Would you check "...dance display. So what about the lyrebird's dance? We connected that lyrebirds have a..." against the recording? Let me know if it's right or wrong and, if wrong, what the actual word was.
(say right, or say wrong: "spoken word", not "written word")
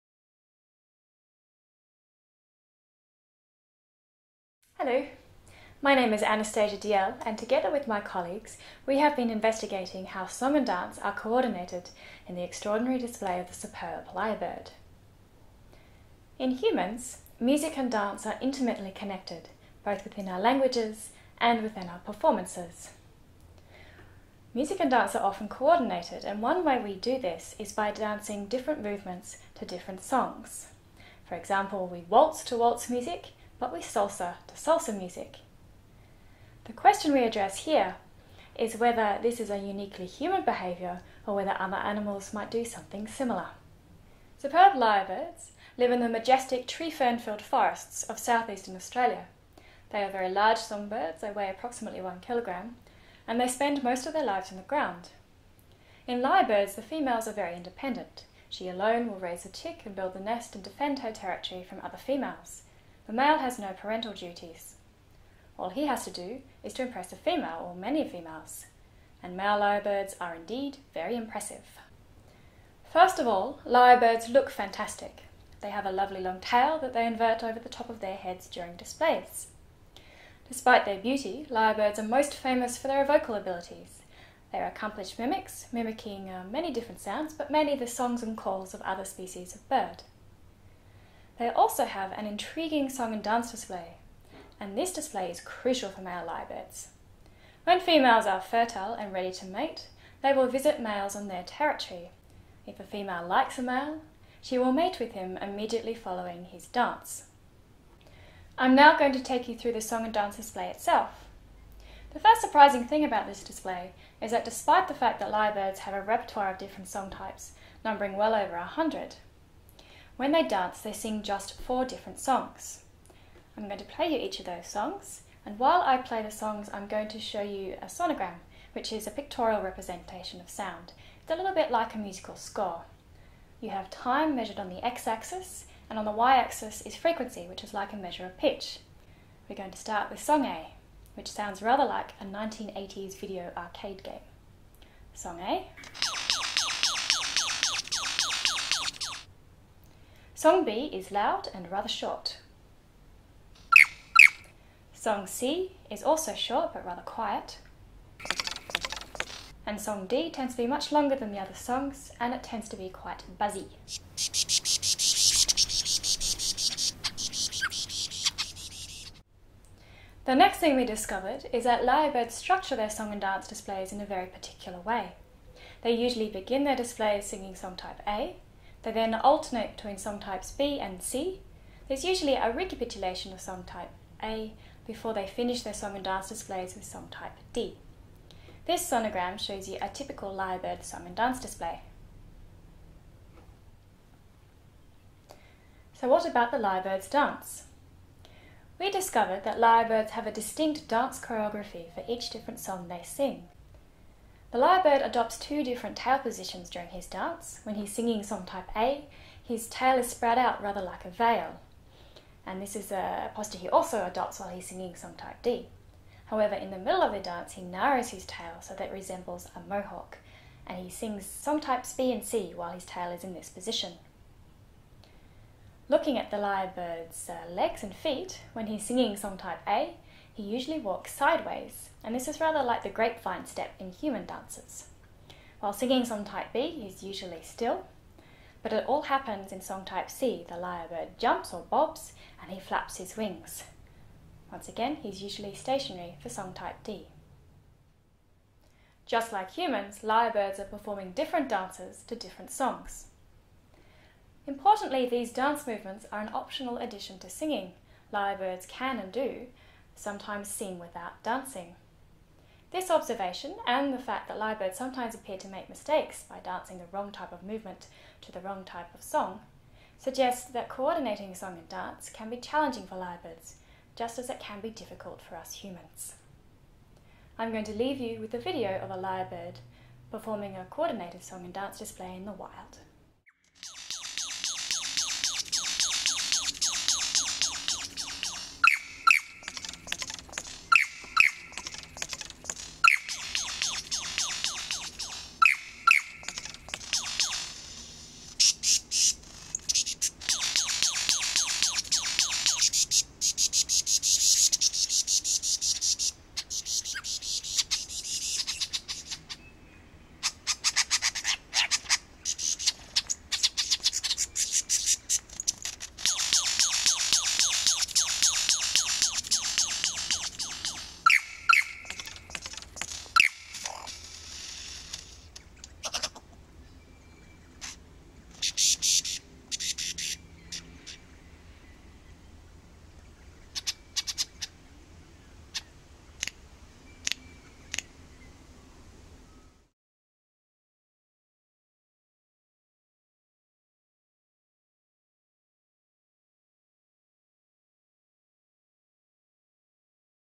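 wrong: "discovered", not "connected".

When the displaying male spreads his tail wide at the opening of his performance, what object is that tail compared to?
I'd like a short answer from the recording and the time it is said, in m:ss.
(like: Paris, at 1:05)
a veil, at 3:31.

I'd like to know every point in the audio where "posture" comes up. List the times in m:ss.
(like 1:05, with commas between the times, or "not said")
3:33.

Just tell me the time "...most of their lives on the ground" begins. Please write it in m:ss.
0:53.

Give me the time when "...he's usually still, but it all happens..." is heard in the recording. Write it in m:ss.
3:56.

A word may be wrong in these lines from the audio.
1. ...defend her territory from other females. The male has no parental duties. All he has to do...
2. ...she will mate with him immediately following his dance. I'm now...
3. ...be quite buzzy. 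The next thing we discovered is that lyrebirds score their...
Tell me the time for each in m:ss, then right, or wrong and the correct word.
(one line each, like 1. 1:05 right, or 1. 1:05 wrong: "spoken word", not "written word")
1. 1:00 right
2. 1:44 right
3. 2:42 wrong: "structure", not "score".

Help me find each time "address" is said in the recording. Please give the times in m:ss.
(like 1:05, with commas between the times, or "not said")
0:37.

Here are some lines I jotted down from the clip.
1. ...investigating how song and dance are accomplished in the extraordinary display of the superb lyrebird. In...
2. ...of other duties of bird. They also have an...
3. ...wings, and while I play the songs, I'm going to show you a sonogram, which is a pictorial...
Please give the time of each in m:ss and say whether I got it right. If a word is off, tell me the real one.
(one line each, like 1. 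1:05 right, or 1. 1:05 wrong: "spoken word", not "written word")
1. 0:09 wrong: "coordinated", not "accomplished"
2. 1:28 wrong: "species", not "duties"
3. 2:04 wrong: "songs", not "wings".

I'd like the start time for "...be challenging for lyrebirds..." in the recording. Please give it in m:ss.
4:32.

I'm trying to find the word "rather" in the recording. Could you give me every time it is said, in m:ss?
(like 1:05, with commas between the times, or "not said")
2:21, 2:31, 2:36, 3:30, 3:52.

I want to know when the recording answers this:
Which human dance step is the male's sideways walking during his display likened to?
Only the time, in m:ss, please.
3:52.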